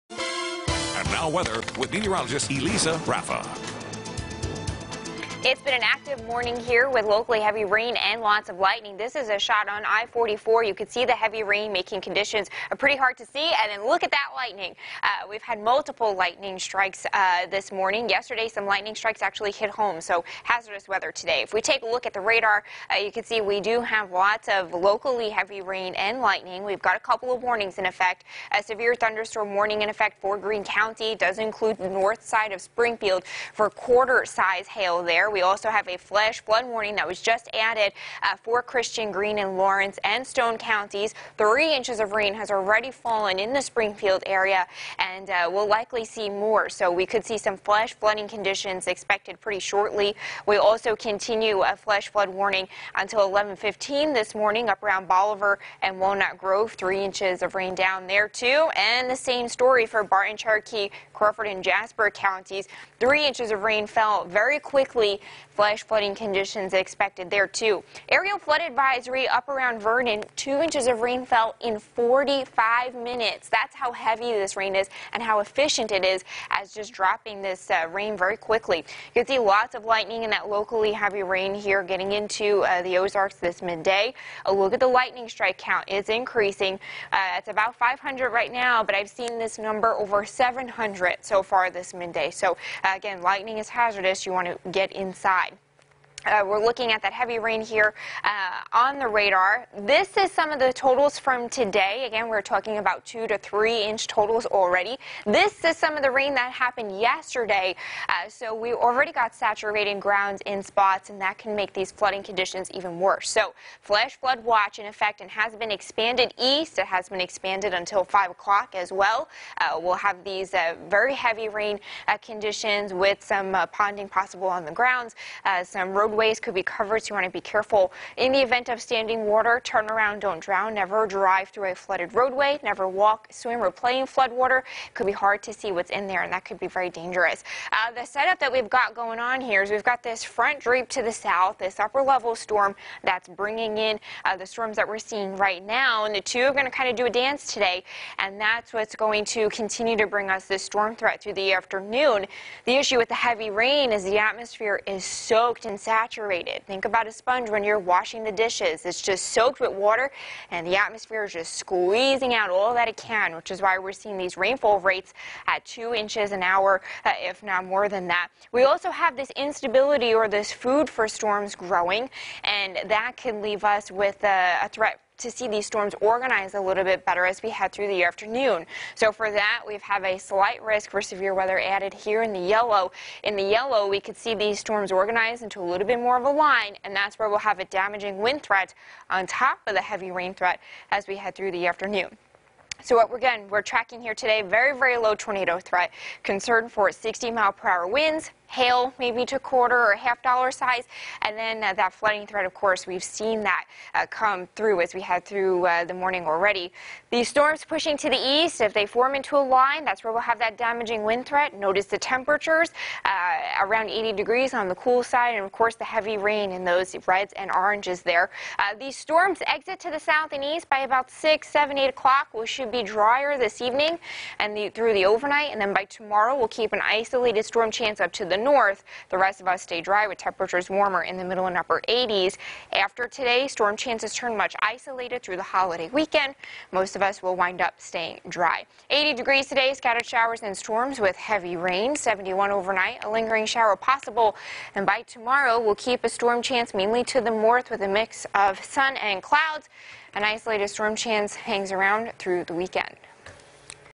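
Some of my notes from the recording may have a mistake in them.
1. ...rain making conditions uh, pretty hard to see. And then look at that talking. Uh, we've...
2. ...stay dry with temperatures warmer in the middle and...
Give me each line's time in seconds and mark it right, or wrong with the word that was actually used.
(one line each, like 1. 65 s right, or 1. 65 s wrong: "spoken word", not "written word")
1. 11 s wrong: "lightning", not "talking"
2. 229 s right.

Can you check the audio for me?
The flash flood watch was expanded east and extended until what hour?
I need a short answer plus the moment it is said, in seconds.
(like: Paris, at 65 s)
5 o'clock, at 118 s.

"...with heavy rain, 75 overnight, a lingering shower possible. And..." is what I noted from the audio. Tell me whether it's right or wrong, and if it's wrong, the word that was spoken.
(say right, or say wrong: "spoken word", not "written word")
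wrong: "71", not "75".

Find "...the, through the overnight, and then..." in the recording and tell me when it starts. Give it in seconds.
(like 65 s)
224 s.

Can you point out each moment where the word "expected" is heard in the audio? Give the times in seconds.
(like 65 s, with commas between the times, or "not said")
48 s, 66 s.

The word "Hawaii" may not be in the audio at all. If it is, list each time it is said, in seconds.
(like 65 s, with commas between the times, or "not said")
not said.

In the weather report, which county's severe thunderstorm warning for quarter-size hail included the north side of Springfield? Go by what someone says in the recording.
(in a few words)
Greene County.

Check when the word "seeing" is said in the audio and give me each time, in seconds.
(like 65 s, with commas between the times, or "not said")
144 s, 163 s.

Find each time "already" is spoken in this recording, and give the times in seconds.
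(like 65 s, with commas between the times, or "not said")
42 s, 104 s, 108 s, 206 s.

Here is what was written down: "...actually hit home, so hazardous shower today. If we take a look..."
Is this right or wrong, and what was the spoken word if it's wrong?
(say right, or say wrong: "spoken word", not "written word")
wrong: "weather", not "shower".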